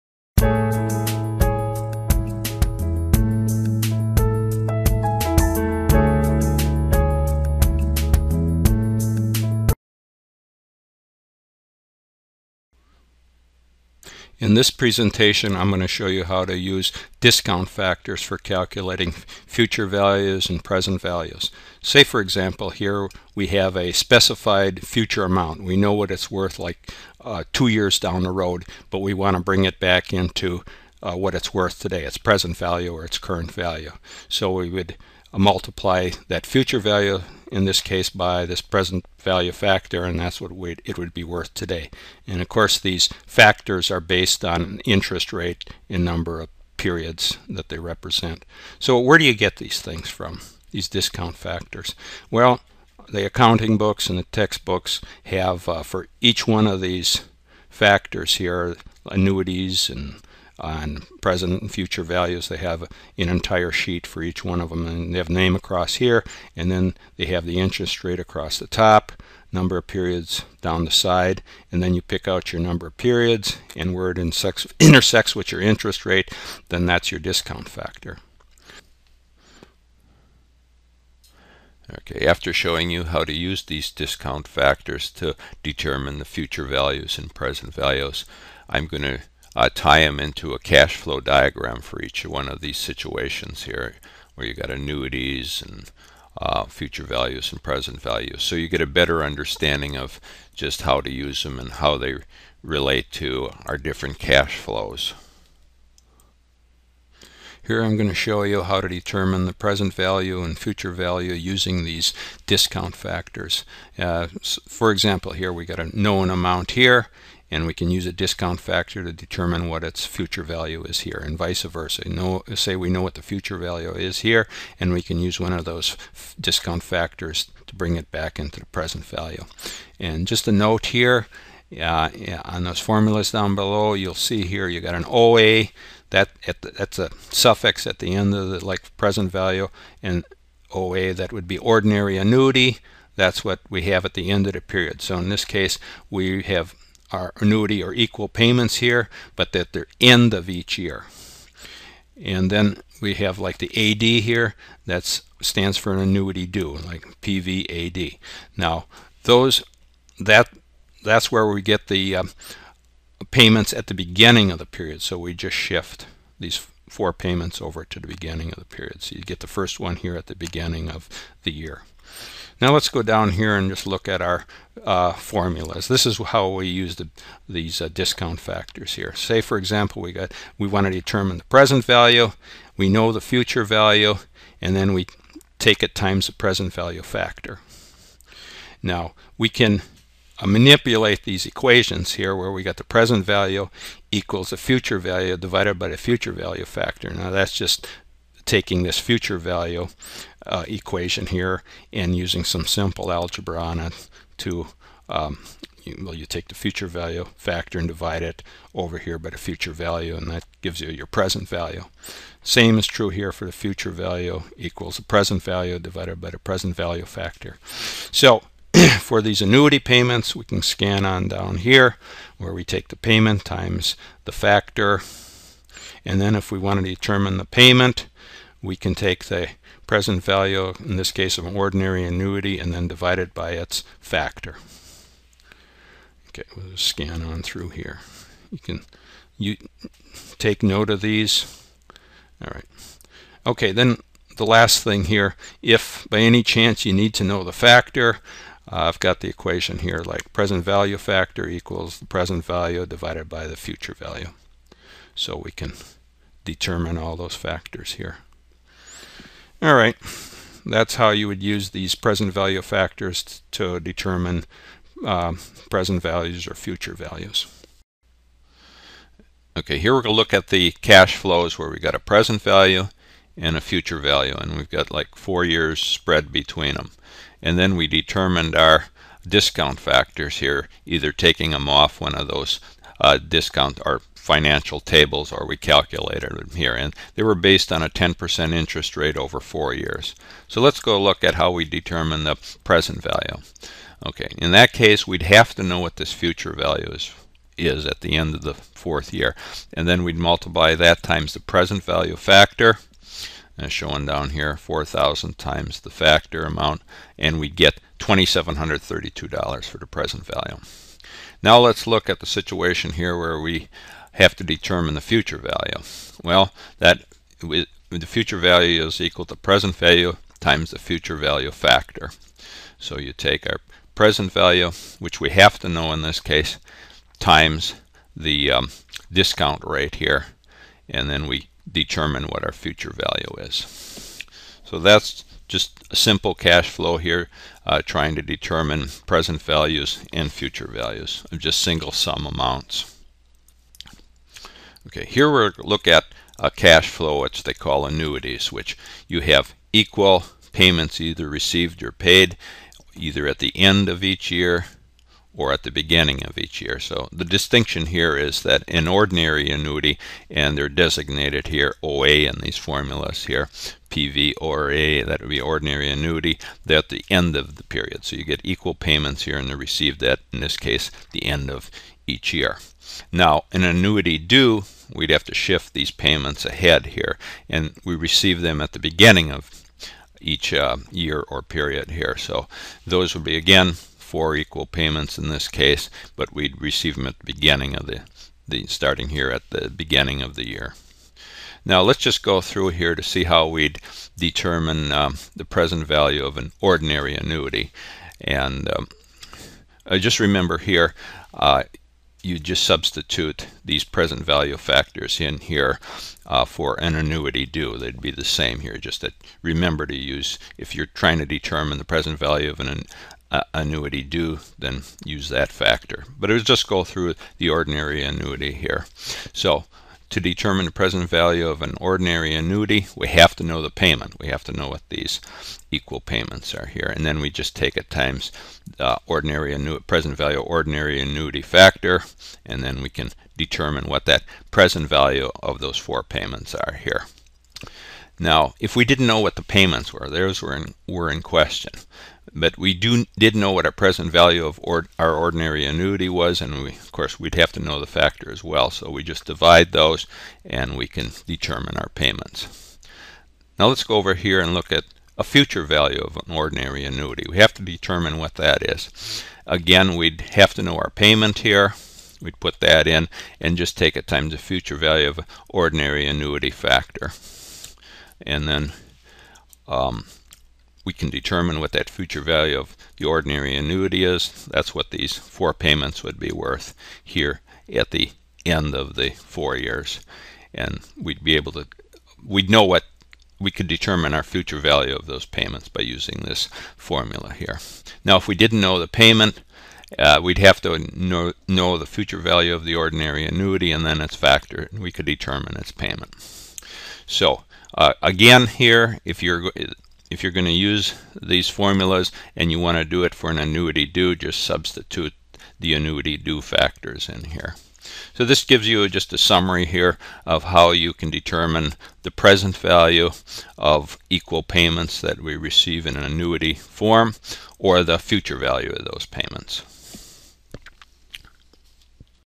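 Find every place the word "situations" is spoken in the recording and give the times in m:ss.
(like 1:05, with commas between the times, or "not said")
1:32, 5:12.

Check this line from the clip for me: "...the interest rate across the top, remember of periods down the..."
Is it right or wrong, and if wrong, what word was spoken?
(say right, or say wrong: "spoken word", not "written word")
wrong: "number", not "remember".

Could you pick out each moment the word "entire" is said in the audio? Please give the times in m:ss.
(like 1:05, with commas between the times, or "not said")
1:03.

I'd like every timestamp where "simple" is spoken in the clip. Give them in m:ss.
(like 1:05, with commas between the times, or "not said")
3:22, 5:35.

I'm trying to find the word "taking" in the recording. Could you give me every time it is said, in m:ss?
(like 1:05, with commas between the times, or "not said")
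3:18, 4:41.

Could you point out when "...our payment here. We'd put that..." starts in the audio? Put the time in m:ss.
7:40.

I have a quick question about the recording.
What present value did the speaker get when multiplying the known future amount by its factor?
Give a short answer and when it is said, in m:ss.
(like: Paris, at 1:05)
$2,732, at 5:08.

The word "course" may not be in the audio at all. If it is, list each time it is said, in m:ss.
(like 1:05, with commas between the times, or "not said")
0:42, 7:26.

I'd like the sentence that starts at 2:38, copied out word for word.
Now, those that that's where we get the um, payments at the beginning of the period.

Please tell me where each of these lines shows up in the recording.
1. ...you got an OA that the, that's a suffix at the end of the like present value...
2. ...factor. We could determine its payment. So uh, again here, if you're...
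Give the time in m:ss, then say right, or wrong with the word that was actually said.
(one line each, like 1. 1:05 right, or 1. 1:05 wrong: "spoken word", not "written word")
1. 2:14 right
2. 8:14 right.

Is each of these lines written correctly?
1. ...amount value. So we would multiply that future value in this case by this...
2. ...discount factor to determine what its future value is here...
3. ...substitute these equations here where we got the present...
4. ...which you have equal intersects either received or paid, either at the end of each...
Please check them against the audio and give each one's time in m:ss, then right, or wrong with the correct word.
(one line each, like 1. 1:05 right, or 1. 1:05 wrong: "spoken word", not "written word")
1. 0:33 wrong: "current", not "amount"
2. 1:58 right
3. 3:10 wrong: "manipulate", not "substitute"
4. 5:48 wrong: "payments", not "intersects".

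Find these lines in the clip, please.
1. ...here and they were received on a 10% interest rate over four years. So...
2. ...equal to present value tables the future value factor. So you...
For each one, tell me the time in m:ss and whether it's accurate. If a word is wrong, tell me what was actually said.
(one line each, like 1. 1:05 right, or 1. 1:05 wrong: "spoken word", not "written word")
1. 4:46 wrong: "based", not "received"
2. 5:18 wrong: "times", not "tables".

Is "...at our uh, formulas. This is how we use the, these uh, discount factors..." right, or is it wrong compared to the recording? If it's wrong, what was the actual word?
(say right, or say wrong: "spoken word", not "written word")
right.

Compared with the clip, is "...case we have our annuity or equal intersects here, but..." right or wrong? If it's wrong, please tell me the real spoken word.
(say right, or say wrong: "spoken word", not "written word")
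wrong: "payments", not "intersects".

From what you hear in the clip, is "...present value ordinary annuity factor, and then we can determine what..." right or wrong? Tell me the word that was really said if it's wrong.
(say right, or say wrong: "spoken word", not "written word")
right.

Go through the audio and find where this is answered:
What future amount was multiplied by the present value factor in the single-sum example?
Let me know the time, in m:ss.
5:04.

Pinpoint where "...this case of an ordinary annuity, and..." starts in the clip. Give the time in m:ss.
3:50.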